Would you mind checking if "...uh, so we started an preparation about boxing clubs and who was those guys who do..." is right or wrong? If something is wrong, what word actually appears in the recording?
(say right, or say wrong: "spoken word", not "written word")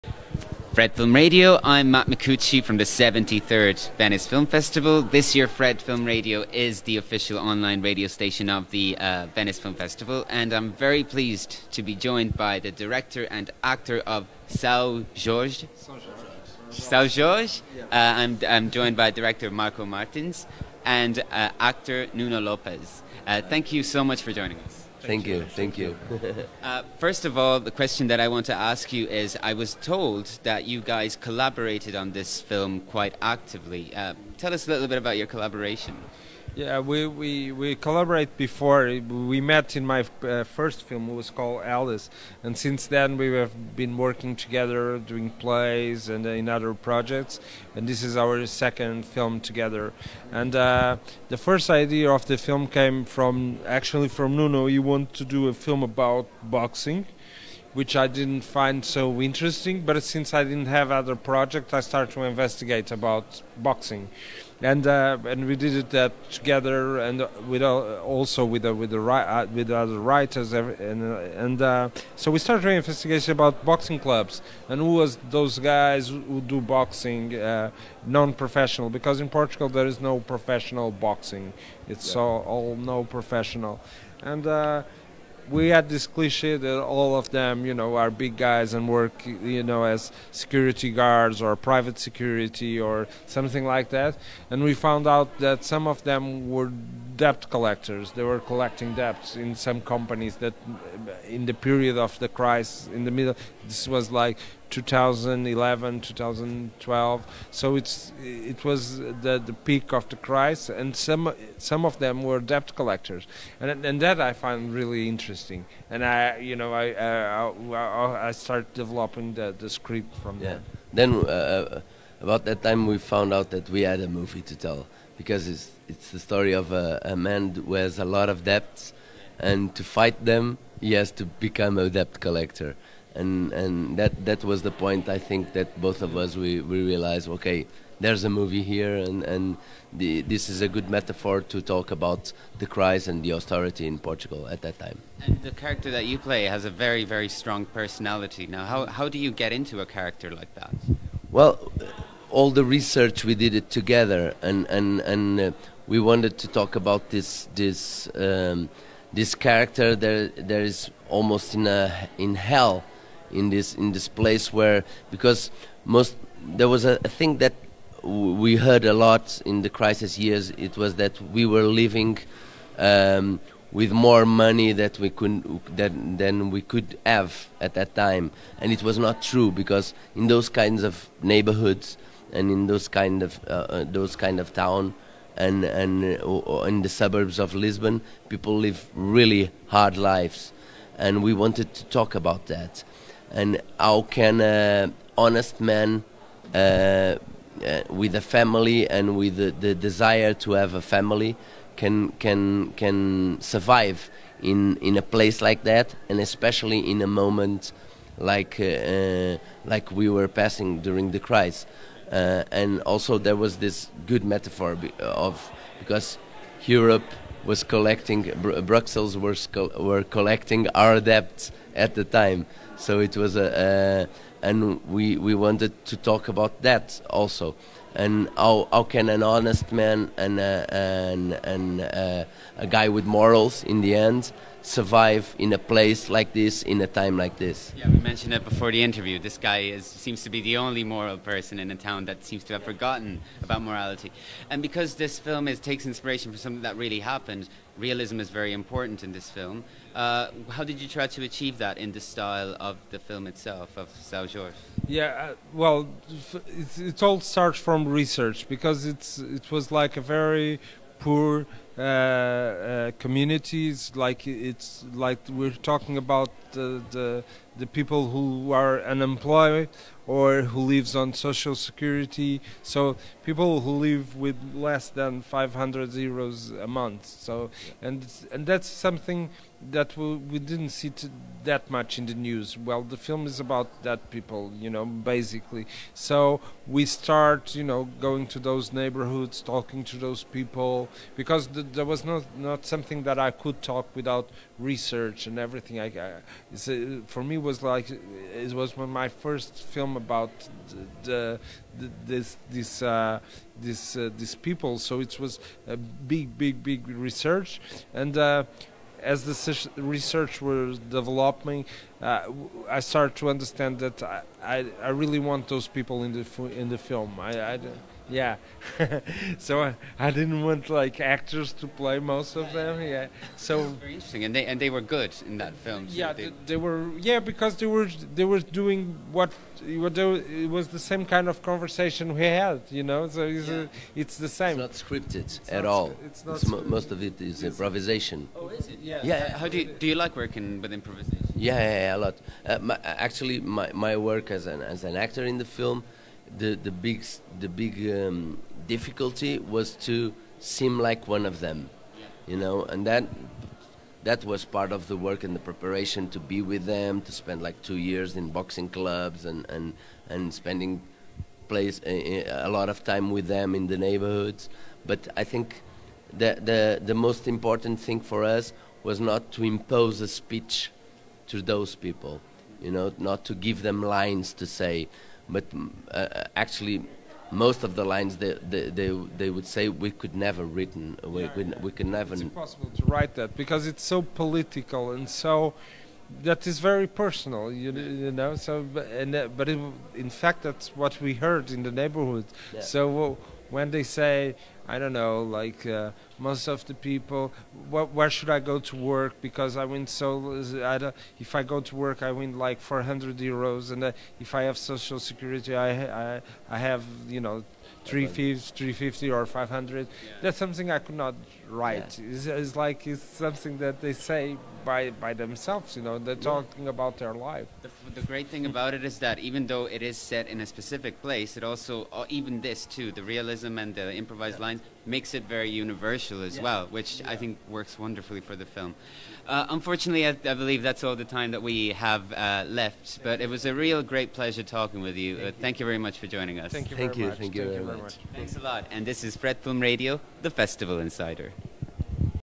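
wrong: "investigation", not "preparation".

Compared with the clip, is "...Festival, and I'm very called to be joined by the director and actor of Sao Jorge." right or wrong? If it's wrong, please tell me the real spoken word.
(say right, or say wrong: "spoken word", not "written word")
wrong: "pleased", not "called".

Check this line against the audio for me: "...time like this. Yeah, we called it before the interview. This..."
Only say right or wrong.
wrong.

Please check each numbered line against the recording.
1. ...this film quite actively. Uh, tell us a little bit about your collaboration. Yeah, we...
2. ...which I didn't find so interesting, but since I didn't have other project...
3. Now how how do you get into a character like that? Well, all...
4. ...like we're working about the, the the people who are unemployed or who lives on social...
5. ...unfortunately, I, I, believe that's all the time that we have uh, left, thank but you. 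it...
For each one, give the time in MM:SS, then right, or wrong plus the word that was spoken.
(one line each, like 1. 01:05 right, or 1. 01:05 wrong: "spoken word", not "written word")
1. 00:32 right
2. 00:57 right
3. 02:28 right
4. 04:24 wrong: "talking", not "working"
5. 07:09 right.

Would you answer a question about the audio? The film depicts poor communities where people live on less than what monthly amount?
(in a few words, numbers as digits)
500 euros.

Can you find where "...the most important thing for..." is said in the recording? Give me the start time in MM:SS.
06:06.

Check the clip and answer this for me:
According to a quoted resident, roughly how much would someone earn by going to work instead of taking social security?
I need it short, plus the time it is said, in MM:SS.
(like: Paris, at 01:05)
400 euros, at 06:42.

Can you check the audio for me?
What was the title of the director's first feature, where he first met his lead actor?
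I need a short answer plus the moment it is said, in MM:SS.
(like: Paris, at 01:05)
Alice, at 00:41.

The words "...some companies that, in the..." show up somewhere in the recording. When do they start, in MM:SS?
01:39.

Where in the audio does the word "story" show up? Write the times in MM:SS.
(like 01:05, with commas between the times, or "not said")
02:06.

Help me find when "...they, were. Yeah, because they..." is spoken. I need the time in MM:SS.
05:26.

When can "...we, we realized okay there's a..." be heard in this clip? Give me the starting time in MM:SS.
02:16.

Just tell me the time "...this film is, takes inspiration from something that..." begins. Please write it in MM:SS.
04:04.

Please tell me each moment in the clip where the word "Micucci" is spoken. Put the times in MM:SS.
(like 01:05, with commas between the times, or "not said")
00:02.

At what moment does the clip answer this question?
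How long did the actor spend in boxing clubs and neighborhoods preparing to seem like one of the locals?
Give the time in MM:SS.
05:57.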